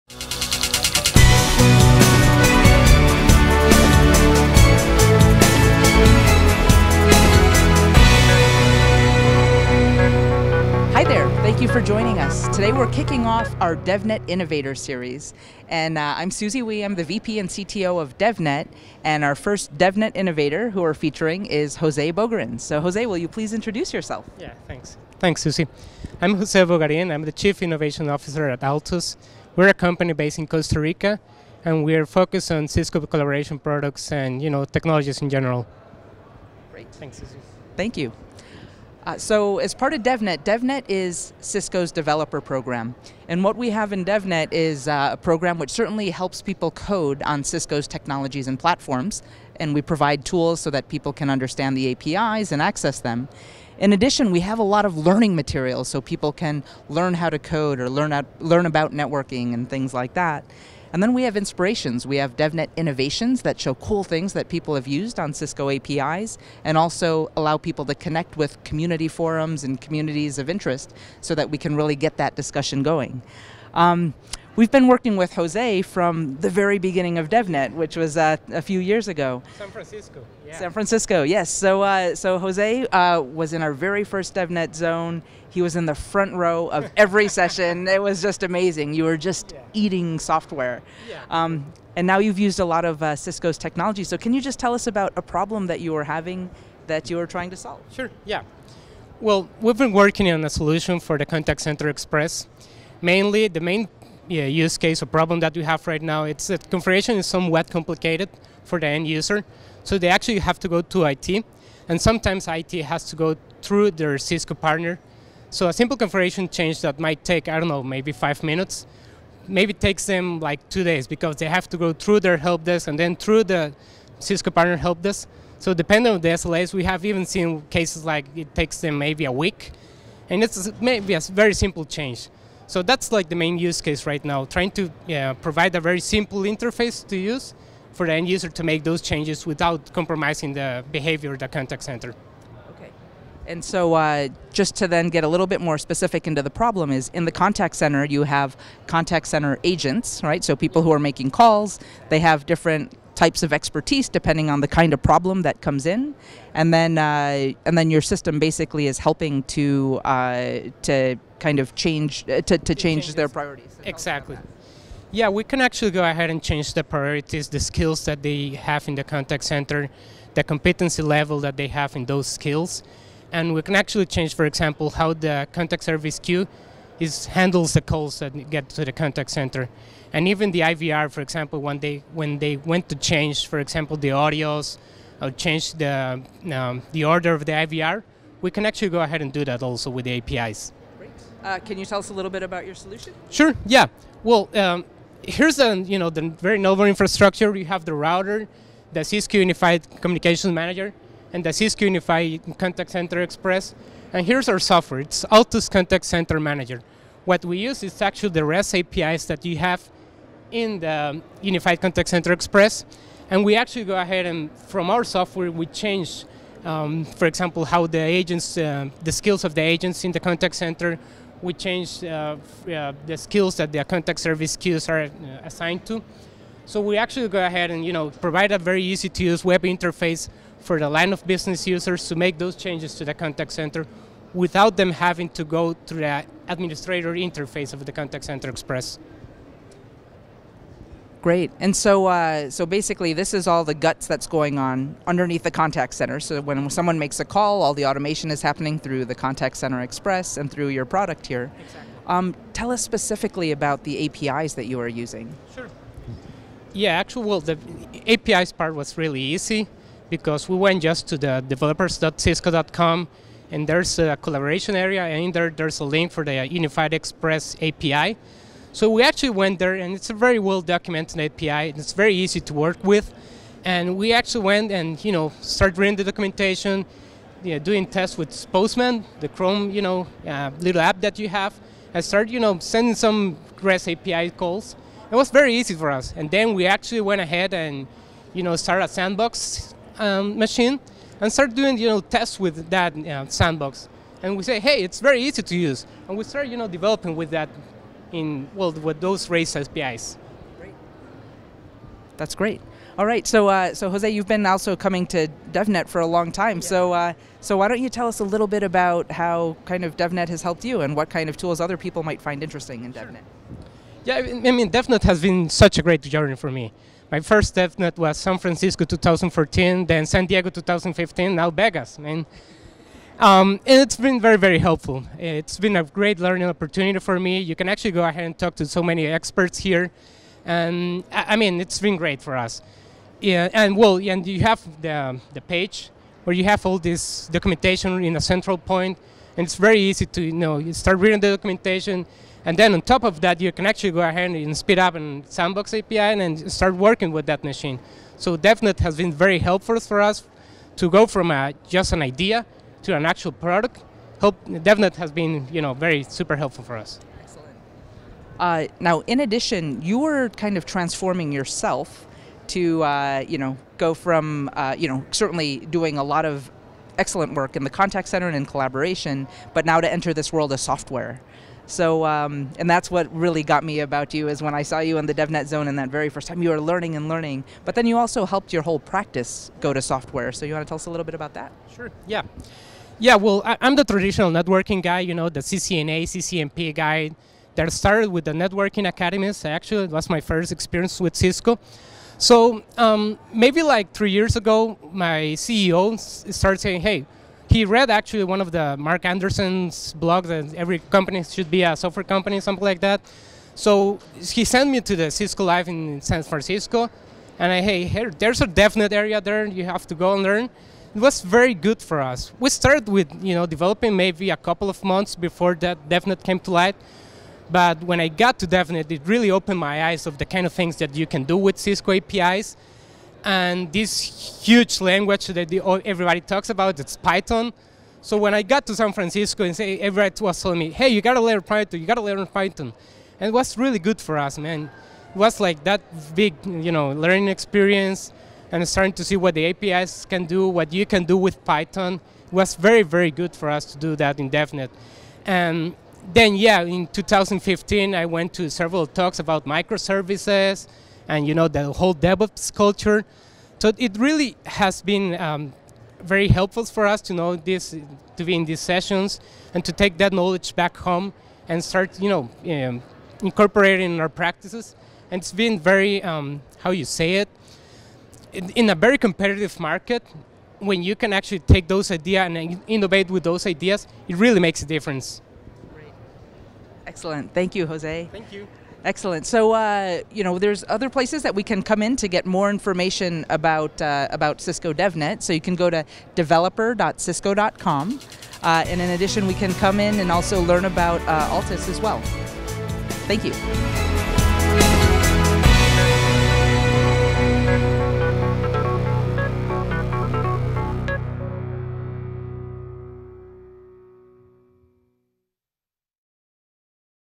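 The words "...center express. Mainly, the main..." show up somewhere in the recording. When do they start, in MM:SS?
01:41.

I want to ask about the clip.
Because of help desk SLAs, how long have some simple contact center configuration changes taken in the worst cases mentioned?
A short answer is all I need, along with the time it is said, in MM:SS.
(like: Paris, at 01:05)
a week, at 02:08.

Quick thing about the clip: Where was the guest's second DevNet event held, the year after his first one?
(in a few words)
San Diego.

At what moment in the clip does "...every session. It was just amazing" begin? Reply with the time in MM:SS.
01:26.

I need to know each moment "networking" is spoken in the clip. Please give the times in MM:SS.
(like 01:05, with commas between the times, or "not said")
00:58, 06:24, 06:28.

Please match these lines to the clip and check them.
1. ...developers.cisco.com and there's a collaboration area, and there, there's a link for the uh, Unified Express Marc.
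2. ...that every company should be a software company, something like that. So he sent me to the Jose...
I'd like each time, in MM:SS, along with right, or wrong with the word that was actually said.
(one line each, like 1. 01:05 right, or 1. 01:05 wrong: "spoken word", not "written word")
1. 04:21 wrong: "API", not "Marc"
2. 06:40 wrong: "Cisco", not "Jose".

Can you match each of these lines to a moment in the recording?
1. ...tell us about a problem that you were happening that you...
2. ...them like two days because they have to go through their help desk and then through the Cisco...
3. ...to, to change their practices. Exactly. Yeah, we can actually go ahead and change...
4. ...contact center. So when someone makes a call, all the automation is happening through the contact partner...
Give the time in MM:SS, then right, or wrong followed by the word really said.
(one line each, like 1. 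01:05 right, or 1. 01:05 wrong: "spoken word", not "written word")
1. 01:34 wrong: "having", not "happening"
2. 02:00 right
3. 02:42 wrong: "priorities", not "practices"
4. 04:05 wrong: "center", not "partner".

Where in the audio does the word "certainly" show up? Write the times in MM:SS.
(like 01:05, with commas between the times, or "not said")
00:45, 06:05.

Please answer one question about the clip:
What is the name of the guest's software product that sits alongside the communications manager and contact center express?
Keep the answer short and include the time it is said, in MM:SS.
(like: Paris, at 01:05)
Altus Contact Center Manager, at 03:25.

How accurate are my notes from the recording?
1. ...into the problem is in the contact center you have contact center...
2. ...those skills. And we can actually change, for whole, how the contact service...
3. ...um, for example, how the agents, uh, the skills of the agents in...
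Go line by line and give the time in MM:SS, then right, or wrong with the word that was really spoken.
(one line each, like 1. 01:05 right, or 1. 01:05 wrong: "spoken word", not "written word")
1. 02:26 right
2. 02:52 wrong: "example", not "whole"
3. 03:36 right.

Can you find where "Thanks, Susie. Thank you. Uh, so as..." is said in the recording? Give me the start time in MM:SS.
00:36.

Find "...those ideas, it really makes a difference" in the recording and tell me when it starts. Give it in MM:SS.
07:53.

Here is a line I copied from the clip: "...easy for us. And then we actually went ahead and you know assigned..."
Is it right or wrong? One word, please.
wrong.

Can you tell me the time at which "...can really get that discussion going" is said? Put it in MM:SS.
01:11.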